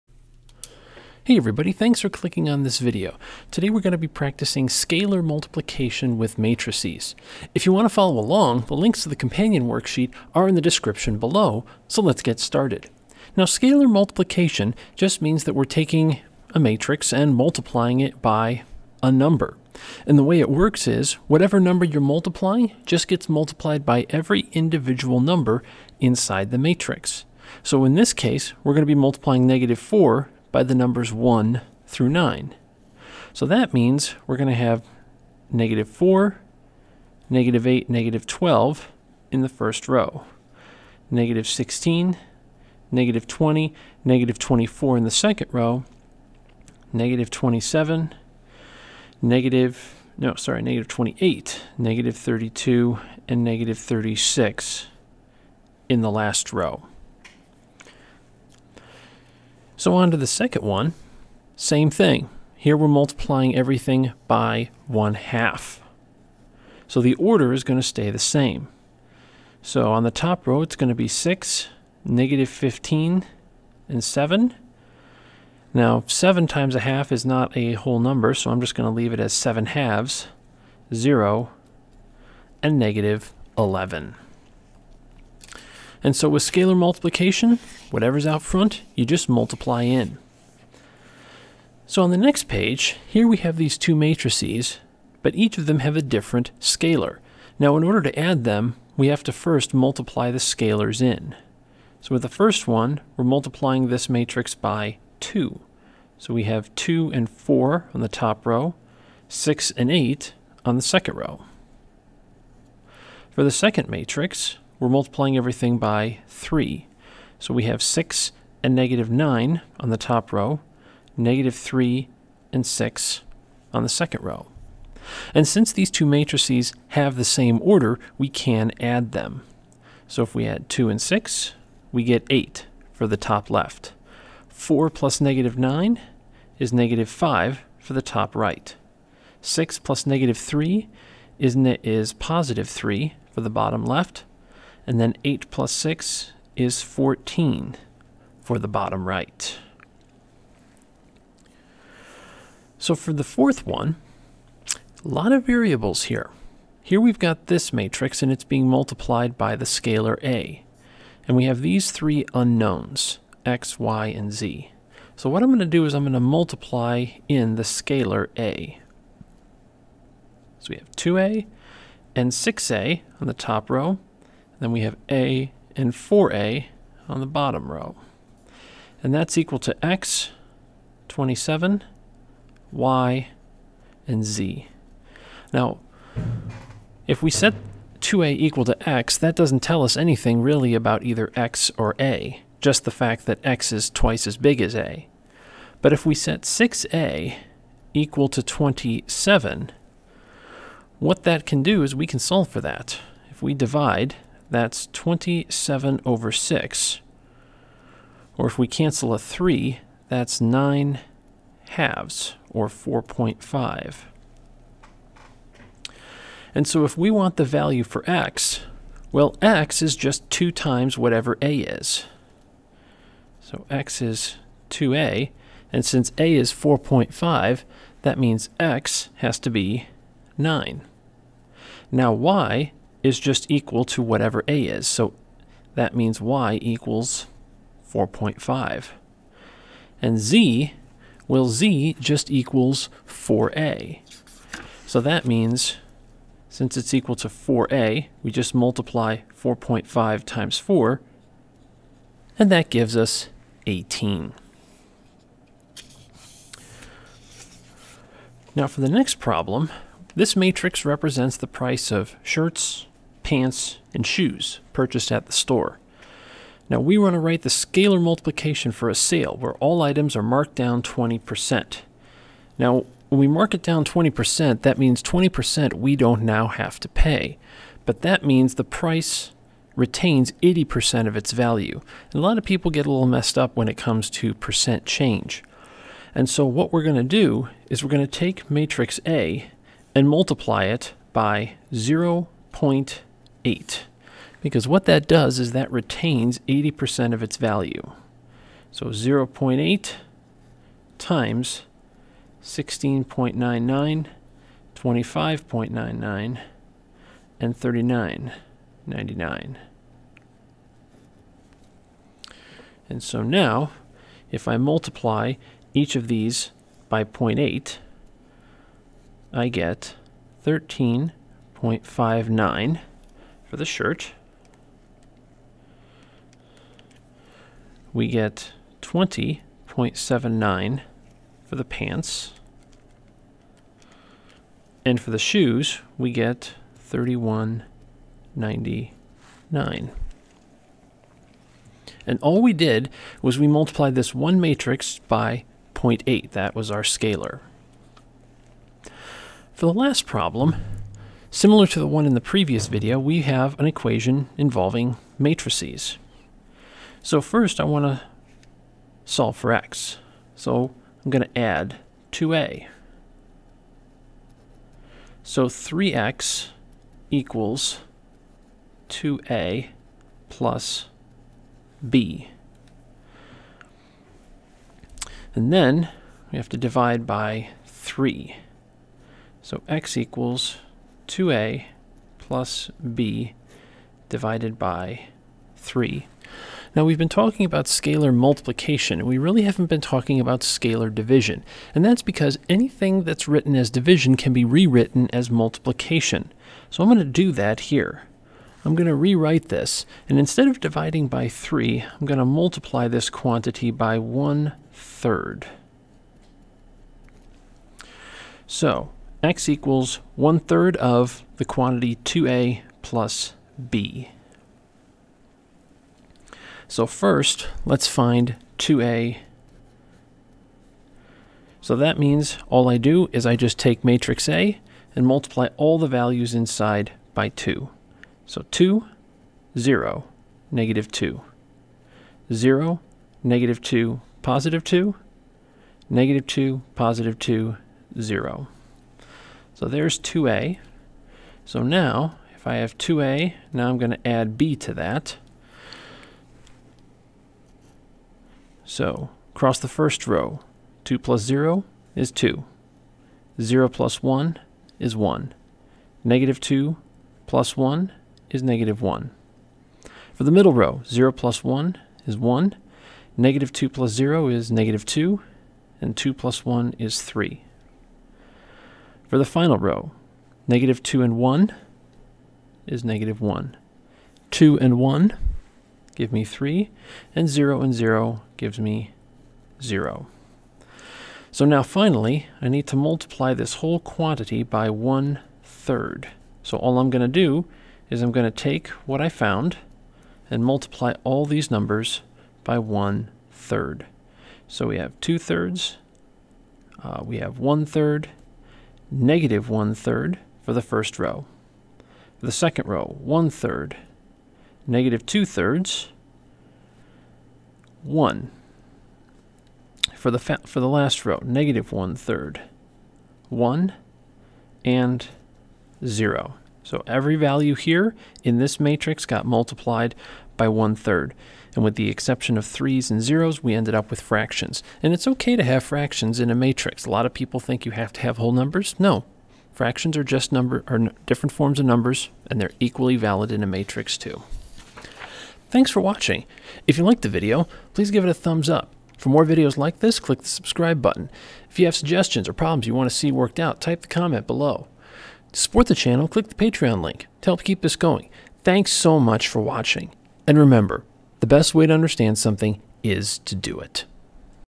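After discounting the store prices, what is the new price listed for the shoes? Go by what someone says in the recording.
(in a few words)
31.99.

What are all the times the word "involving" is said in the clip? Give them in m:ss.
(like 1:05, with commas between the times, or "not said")
5:54.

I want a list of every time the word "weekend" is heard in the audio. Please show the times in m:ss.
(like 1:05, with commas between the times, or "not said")
not said.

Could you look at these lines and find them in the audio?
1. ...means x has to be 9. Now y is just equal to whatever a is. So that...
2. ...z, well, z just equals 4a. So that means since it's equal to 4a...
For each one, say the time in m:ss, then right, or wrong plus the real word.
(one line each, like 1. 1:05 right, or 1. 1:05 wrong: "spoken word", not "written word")
1. 3:48 right
2. 4:00 right.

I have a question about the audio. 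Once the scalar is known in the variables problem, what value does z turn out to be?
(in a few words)
18.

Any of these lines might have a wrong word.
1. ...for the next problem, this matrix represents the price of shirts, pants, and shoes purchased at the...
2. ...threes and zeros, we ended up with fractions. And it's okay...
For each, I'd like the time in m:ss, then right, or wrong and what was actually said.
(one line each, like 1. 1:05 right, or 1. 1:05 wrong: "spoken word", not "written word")
1. 4:18 right
2. 8:42 right.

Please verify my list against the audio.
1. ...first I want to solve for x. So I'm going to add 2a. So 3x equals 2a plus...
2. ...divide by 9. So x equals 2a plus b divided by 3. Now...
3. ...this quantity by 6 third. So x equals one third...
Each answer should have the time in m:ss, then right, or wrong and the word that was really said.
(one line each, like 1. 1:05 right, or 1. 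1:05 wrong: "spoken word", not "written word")
1. 5:57 right
2. 6:16 wrong: "3", not "9"
3. 6:42 wrong: "1", not "6".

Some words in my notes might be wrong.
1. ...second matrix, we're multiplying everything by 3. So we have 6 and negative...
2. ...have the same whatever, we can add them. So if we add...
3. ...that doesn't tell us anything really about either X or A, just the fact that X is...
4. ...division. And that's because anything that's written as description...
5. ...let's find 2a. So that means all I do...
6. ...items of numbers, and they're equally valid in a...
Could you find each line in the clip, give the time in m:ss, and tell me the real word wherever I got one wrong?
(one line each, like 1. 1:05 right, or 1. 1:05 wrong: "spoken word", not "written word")
1. 1:53 right
2. 2:06 wrong: "order", not "whatever"
3. 3:09 right
4. 6:30 wrong: "division", not "description"
5. 6:57 right
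6. 8:51 wrong: "forms", not "items".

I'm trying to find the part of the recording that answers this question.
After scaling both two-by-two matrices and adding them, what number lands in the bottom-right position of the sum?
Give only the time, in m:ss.
2:26.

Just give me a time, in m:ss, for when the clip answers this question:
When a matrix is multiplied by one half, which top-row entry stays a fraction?
1:19.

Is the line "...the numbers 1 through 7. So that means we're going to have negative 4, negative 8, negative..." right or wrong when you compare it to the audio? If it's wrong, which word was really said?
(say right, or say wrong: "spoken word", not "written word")
wrong: "9", not "7".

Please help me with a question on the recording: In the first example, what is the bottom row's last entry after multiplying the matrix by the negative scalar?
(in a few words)
-36.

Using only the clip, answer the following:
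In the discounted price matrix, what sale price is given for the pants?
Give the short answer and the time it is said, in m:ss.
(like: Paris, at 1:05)
20.79, at 5:28.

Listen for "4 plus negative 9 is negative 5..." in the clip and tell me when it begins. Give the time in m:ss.
2:14.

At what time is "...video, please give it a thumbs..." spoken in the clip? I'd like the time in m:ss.
8:57.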